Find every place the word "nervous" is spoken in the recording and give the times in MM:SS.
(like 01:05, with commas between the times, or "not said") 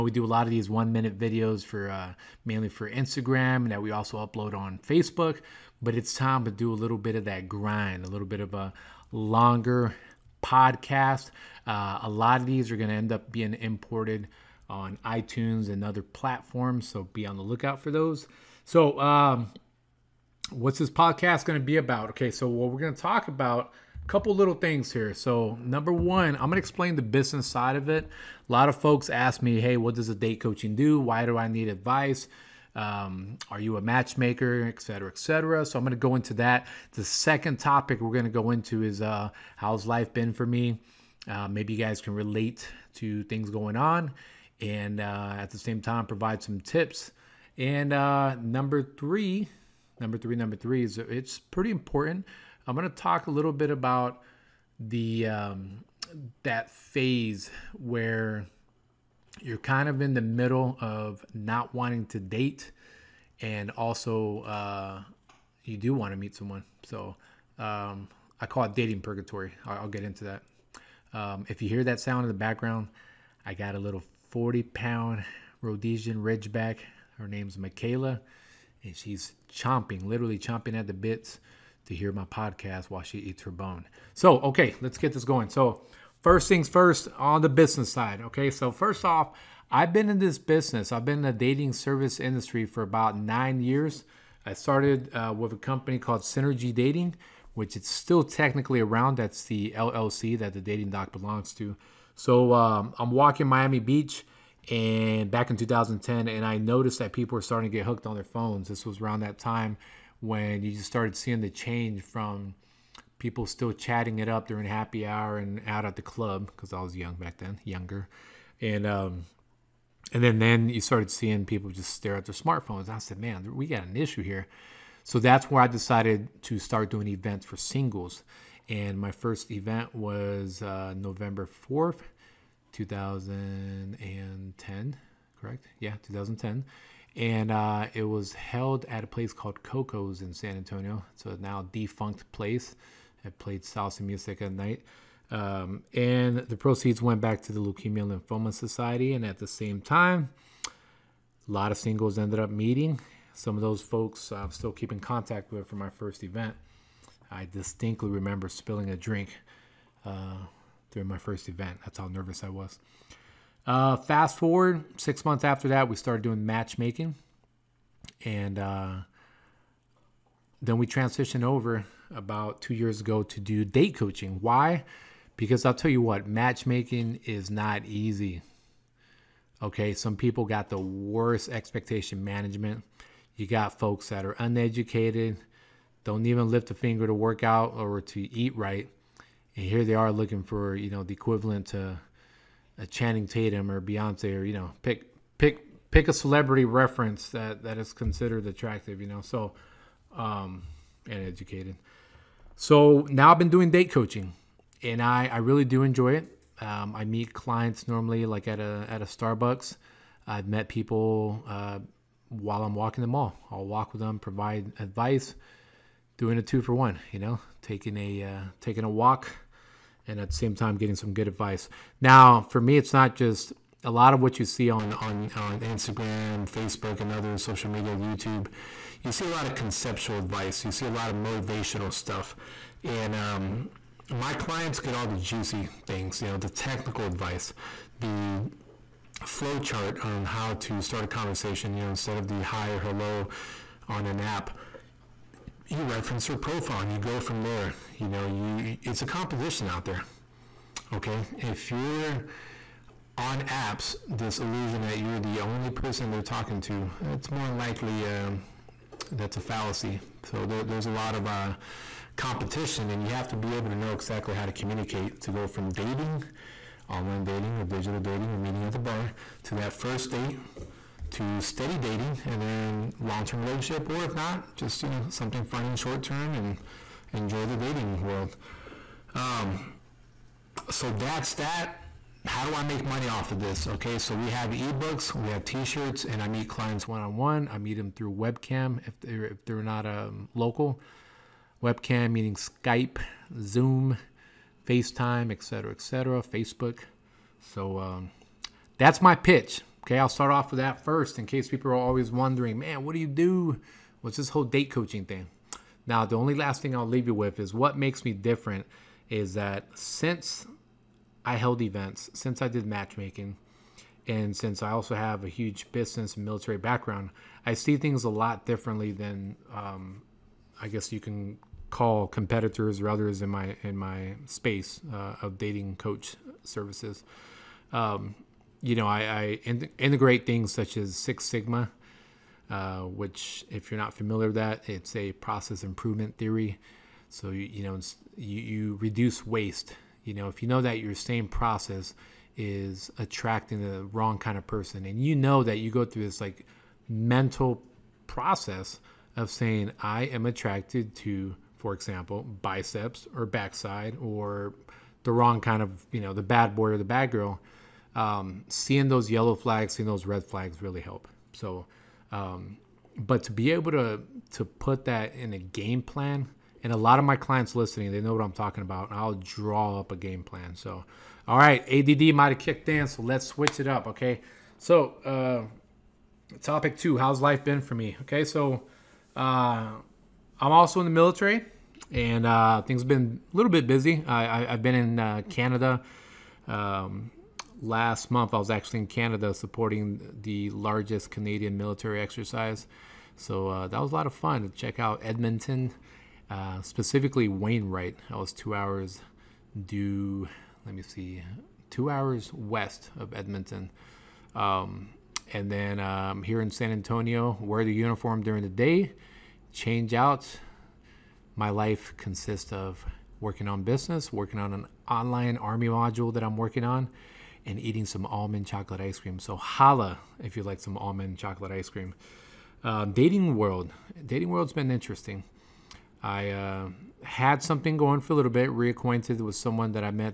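02:42.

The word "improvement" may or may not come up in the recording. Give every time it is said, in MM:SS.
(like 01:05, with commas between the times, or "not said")
05:35.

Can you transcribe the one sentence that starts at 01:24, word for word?
So, okay, let's get this going.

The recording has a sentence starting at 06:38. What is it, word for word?
I was two hours due, let me see, two hours west of Edmonton.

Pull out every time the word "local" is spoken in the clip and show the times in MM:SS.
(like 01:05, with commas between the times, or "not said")
04:50.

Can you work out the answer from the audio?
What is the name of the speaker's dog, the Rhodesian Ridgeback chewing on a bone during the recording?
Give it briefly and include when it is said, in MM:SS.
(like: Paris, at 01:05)
Michaela, at 01:17.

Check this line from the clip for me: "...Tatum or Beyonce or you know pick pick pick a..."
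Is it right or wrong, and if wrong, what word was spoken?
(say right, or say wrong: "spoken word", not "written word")
right.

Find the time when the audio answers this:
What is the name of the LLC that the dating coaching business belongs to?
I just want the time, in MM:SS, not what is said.
01:36.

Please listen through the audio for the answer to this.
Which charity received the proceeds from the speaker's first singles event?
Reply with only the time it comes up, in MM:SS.
02:27.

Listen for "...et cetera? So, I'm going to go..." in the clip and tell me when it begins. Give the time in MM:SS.
00:35.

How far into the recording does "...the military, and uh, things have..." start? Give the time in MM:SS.
06:20.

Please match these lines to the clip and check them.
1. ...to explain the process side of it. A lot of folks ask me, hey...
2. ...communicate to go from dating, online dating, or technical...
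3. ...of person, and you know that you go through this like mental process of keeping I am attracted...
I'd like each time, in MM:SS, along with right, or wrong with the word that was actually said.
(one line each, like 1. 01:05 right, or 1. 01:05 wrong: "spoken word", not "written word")
1. 00:26 wrong: "business", not "process"
2. 04:24 wrong: "digital", not "technical"
3. 05:44 wrong: "saying", not "keeping".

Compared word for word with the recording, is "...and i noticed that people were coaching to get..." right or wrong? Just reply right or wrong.
wrong.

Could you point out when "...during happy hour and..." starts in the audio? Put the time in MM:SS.
01:54.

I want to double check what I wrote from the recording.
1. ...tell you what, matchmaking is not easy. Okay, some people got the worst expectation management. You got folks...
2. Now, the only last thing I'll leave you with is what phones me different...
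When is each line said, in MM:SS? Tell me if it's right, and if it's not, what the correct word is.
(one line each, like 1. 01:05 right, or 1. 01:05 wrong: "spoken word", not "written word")
1. 02:55 right
2. 05:05 wrong: "makes", not "phones".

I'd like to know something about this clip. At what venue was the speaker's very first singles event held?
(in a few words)
Coco's.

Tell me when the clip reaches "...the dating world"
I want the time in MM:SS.
04:37.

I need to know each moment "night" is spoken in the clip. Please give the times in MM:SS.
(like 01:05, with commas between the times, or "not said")
02:24.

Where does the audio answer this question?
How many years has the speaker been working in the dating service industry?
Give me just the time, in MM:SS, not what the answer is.
01:33.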